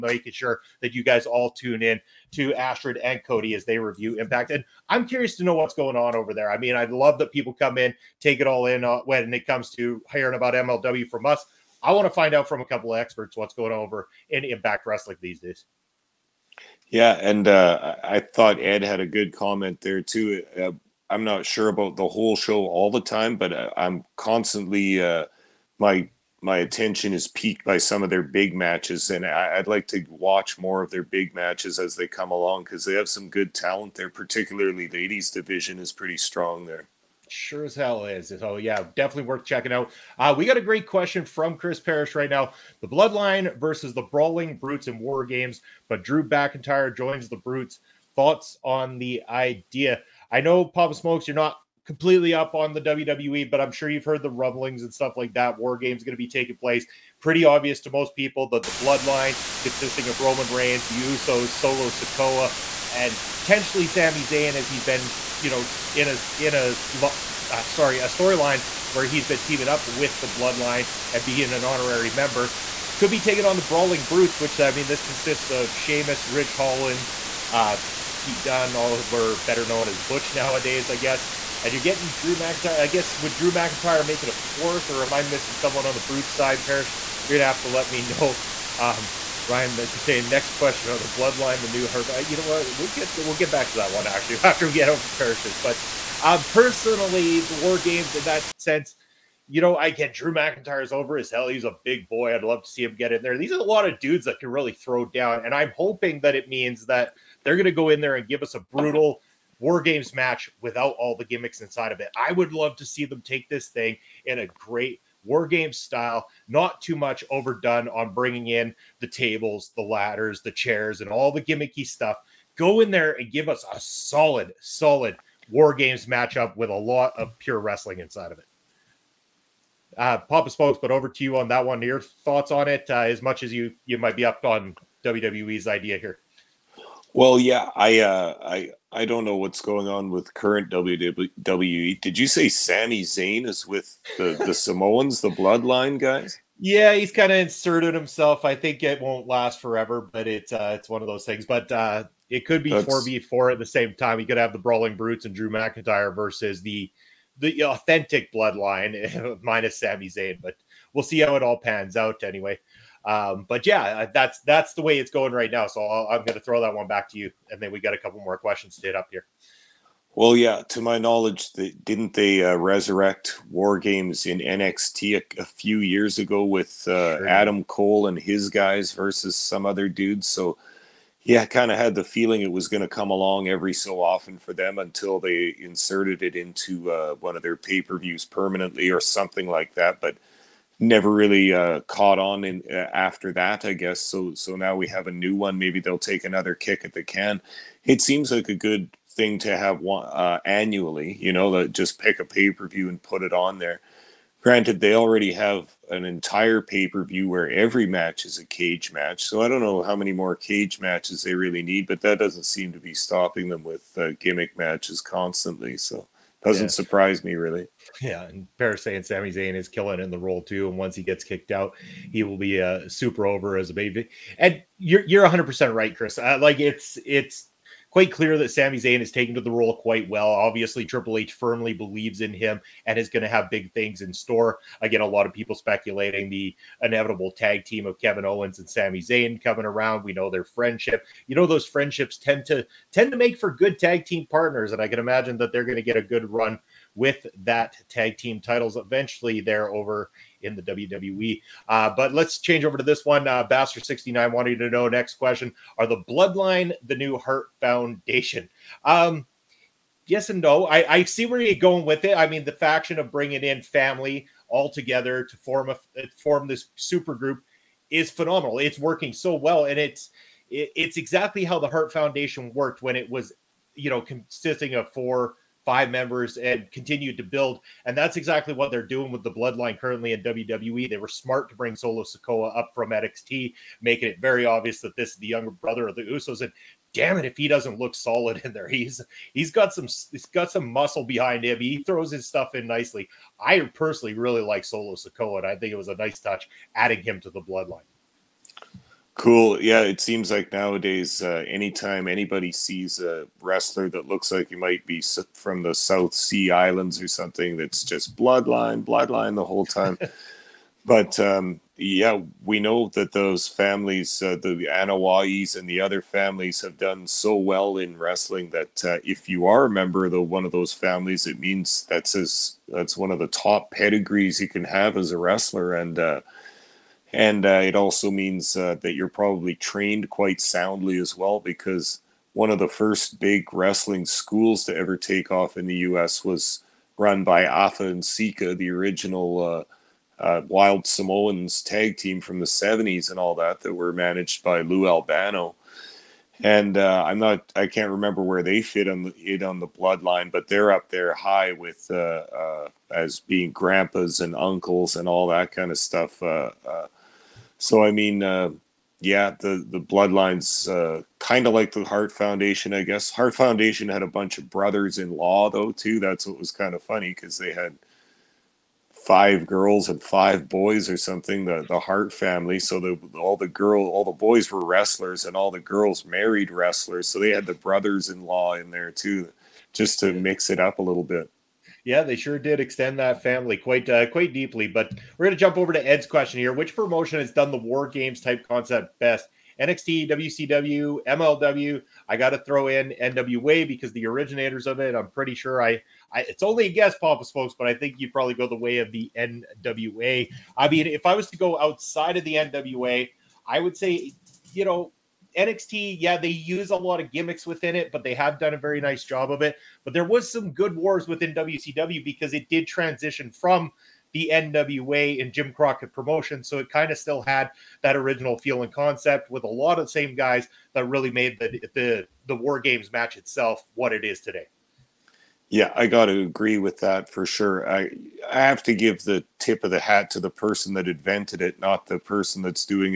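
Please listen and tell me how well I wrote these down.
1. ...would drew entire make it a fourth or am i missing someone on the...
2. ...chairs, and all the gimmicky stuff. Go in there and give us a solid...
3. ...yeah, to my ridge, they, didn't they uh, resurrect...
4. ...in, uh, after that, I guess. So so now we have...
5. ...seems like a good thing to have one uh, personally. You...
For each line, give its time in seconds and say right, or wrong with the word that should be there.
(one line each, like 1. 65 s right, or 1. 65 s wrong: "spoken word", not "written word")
1. 83 s wrong: "mcintyre", not "entire"
2. 120 s right
3. 170 s wrong: "knowledge", not "ridge"
4. 192 s right
5. 198 s wrong: "annually", not "personally".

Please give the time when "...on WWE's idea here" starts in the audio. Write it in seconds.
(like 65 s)
134 s.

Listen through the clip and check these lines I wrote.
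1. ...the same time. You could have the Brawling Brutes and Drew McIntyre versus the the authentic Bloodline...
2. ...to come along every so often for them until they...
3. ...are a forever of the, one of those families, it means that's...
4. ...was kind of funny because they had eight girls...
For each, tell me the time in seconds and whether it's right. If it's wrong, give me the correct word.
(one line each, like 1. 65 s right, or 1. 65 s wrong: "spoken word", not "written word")
1. 153 s right
2. 182 s right
3. 319 s wrong: "member", not "forever"
4. 366 s wrong: "five", not "eight".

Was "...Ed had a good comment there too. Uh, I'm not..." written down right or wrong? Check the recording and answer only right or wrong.
right.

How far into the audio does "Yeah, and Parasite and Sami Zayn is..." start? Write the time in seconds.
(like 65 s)
218 s.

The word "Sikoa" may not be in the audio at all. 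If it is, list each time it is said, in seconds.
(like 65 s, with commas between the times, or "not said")
61 s, 282 s, 294 s.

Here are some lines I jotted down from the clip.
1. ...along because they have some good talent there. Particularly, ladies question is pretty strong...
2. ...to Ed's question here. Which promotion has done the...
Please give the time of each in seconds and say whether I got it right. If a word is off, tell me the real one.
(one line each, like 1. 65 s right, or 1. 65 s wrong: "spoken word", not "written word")
1. 32 s wrong: "division", not "question"
2. 385 s right.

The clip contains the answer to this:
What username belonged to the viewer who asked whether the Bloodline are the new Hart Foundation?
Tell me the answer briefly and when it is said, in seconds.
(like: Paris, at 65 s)
Bastard69, at 253 s.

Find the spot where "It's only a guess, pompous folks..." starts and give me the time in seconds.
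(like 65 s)
396 s.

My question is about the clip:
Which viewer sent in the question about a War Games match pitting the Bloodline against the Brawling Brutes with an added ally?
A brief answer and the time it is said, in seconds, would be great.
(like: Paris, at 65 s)
Chris Parrish, at 41 s.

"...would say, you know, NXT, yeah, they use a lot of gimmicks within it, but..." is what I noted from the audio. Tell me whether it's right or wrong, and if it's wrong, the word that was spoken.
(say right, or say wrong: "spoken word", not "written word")
right.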